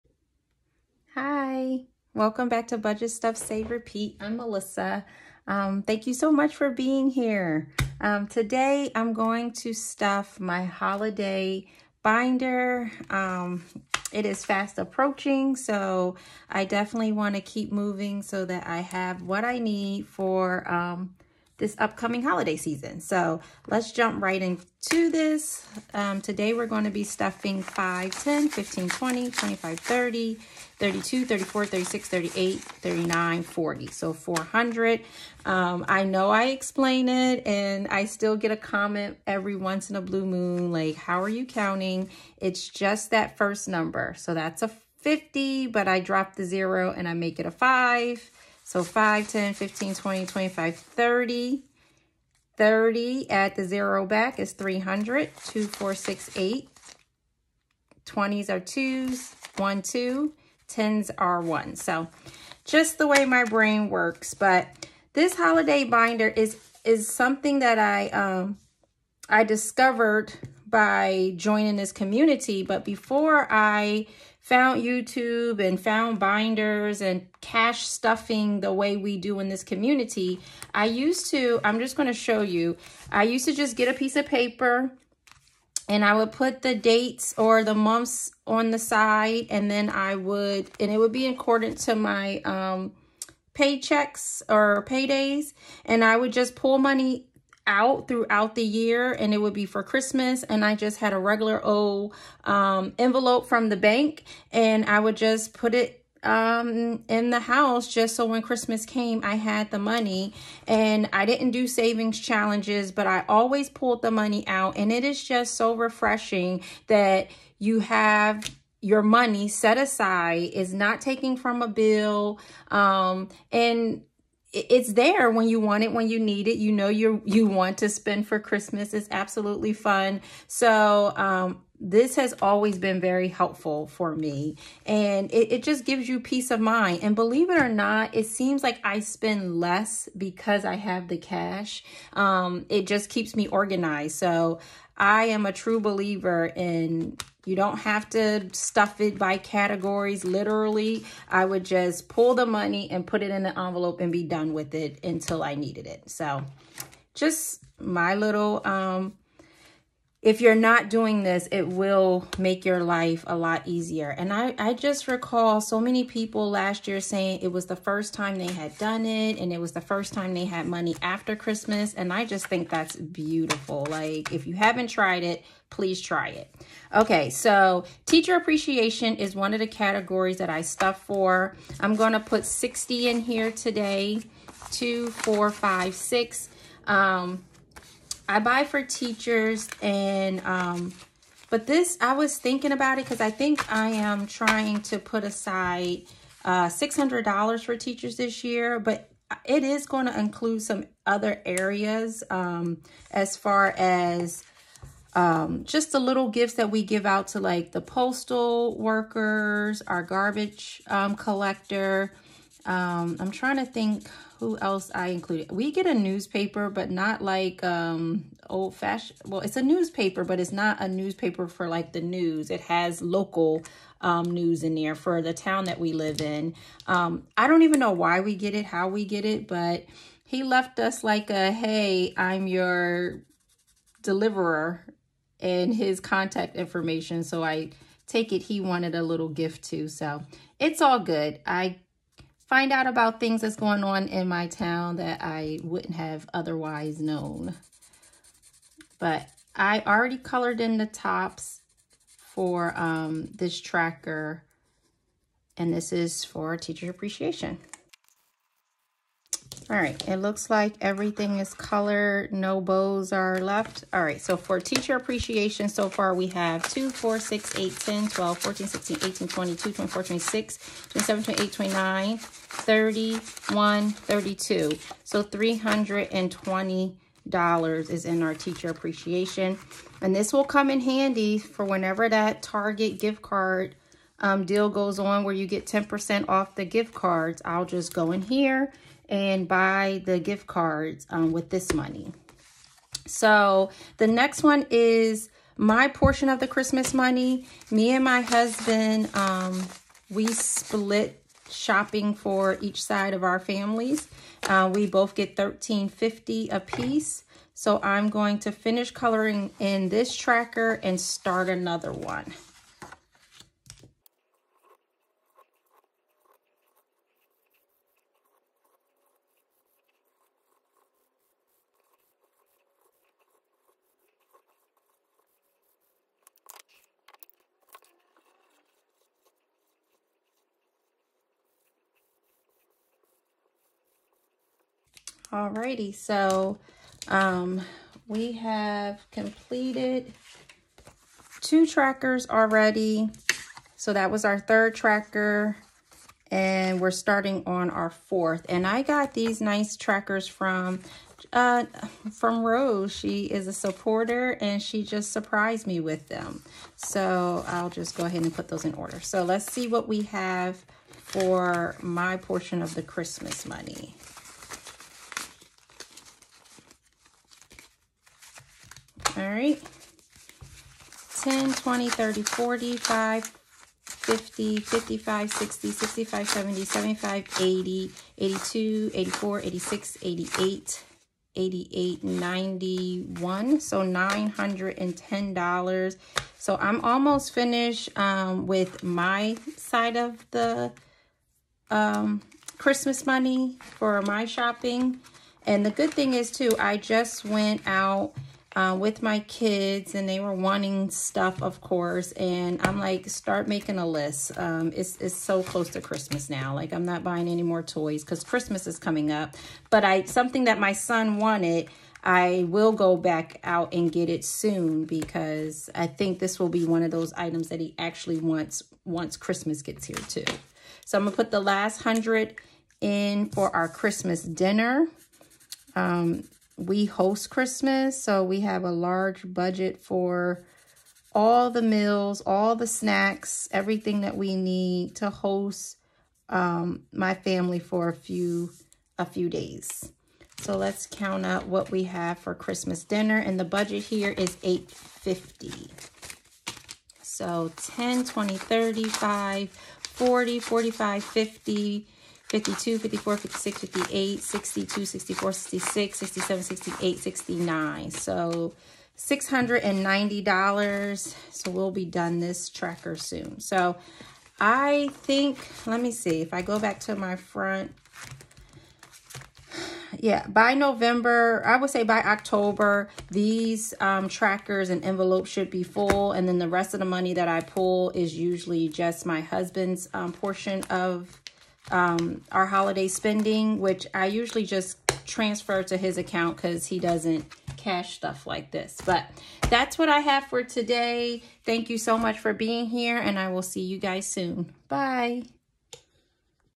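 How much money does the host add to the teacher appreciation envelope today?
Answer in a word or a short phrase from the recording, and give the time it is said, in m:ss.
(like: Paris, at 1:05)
60, at 3:01.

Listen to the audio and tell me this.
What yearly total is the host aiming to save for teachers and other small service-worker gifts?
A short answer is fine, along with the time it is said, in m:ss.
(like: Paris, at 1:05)
$600, at 3:16.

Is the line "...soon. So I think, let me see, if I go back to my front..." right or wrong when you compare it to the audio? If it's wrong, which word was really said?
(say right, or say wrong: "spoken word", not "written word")
right.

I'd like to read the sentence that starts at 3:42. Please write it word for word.
It has local um, news in there for the town that we live in.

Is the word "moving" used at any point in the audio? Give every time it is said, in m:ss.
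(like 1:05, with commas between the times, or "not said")
0:17.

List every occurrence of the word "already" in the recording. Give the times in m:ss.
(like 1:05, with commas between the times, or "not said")
4:09, 5:42.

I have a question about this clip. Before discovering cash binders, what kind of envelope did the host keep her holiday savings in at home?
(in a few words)
envelope from the bank.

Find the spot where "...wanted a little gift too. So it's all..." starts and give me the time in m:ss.
3:58.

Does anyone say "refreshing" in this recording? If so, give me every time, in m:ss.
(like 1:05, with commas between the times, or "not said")
1:55.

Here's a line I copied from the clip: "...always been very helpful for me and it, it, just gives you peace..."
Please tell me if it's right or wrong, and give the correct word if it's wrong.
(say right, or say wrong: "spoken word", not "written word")
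right.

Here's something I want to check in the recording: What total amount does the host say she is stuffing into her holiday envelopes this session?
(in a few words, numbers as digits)
400.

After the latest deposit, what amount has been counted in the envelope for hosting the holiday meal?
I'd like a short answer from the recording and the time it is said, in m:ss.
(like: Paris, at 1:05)
$690, at 7:38.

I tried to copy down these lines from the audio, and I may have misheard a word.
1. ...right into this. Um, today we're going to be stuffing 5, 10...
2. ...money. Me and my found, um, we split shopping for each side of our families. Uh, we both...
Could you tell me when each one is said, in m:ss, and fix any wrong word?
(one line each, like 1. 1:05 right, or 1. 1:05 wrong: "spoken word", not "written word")
1. 0:24 right
2. 4:56 wrong: "husband", not "found".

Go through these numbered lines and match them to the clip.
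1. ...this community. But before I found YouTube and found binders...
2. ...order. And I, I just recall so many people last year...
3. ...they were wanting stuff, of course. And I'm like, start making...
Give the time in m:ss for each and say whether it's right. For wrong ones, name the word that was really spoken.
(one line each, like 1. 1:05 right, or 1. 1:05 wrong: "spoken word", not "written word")
1. 1:11 right
2. 2:43 wrong: "easier", not "order"
3. 6:40 right.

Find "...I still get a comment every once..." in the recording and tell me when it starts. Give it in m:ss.
0:37.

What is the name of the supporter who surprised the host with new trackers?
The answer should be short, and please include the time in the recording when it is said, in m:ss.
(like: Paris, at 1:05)
Rose, at 5:52.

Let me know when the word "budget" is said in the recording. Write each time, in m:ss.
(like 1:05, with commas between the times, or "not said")
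0:02, 7:09, 7:23.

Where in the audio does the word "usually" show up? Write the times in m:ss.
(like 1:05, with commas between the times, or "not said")
7:58, 8:04.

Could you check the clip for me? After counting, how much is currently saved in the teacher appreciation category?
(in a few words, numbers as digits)
$320.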